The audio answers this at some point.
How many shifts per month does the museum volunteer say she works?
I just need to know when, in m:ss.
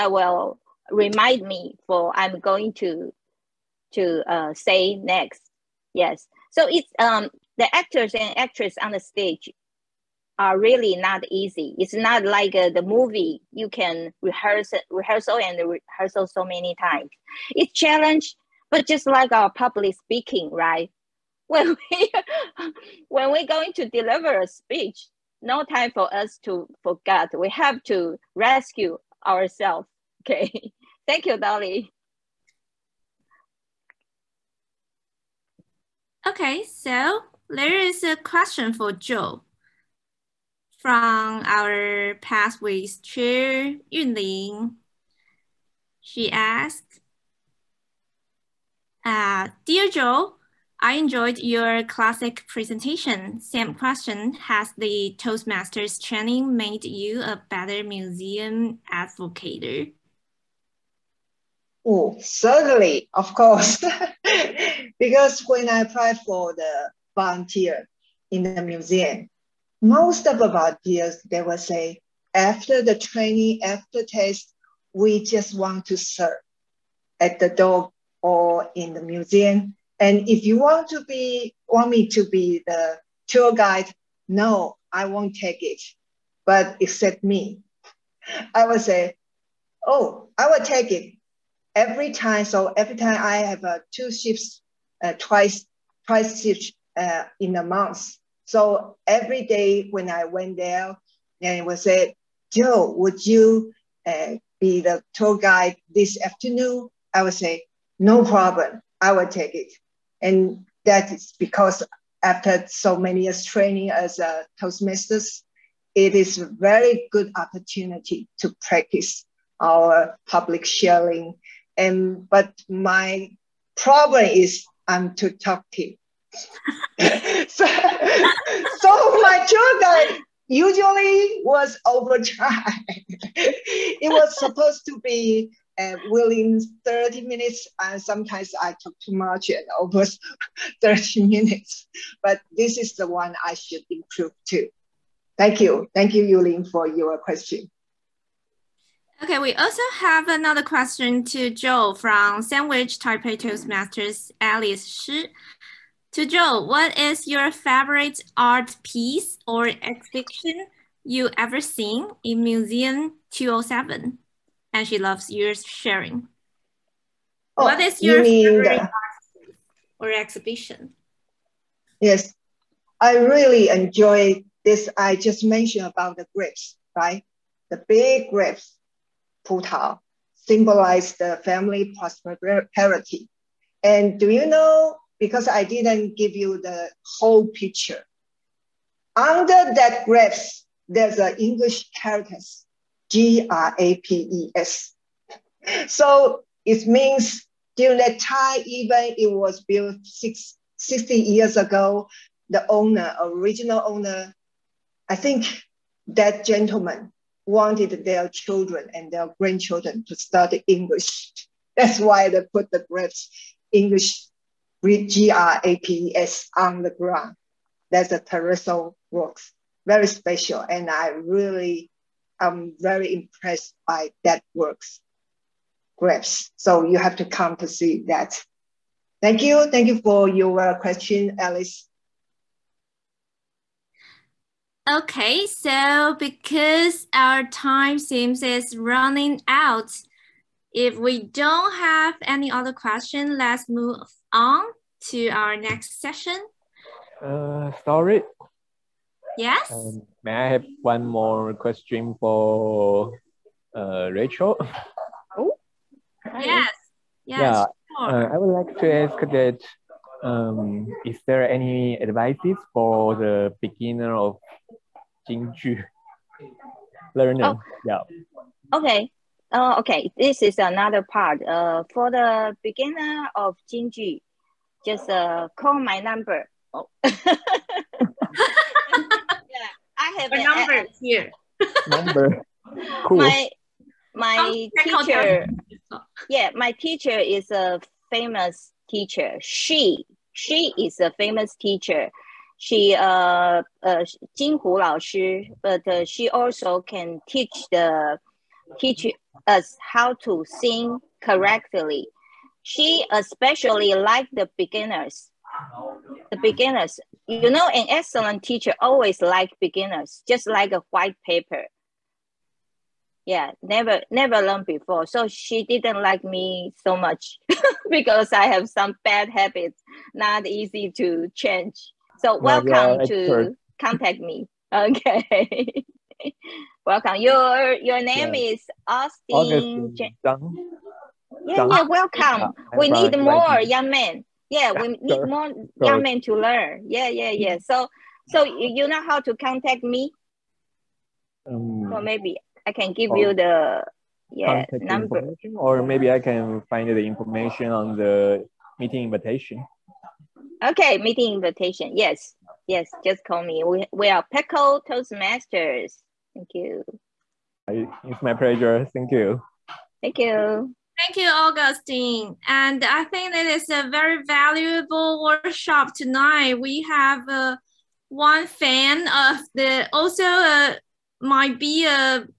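1:33.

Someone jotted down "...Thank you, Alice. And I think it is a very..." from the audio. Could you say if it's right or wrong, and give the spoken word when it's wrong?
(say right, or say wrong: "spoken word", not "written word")
wrong: "Augustine", not "Alice".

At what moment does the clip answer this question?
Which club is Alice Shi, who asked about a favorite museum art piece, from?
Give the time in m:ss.
2:32.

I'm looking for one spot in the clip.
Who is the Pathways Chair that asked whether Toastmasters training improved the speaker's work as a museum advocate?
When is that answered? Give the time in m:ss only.
0:43.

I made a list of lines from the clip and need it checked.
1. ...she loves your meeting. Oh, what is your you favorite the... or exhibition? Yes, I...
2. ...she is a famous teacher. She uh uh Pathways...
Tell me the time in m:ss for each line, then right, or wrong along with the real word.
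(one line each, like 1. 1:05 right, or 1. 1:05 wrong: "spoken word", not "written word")
1. 2:44 wrong: "sharing", not "meeting"
2. 4:50 wrong: "Jin", not "Pathways".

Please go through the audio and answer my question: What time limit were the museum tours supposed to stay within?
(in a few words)
30 minutes.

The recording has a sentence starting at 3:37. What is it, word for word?
That's a terrestrial works, very special, and I really I'm very impressed by that works graphs.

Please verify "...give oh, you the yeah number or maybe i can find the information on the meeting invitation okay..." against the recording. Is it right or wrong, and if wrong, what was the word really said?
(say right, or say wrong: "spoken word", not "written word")
right.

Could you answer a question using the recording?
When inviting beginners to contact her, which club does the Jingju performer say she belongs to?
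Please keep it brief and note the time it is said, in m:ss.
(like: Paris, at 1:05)
PECL Toastmasters, at 5:54.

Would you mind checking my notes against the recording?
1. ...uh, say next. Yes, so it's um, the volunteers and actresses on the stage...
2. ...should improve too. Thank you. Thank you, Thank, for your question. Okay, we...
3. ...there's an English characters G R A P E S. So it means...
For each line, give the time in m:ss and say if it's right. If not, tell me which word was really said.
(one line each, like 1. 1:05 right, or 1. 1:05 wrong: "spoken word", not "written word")
1. 0:04 wrong: "actors", not "volunteers"
2. 2:23 wrong: "Yulin", not "Thank"
3. 3:10 right.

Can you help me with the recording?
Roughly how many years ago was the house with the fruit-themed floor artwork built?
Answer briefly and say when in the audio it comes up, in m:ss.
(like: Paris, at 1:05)
60, at 3:20.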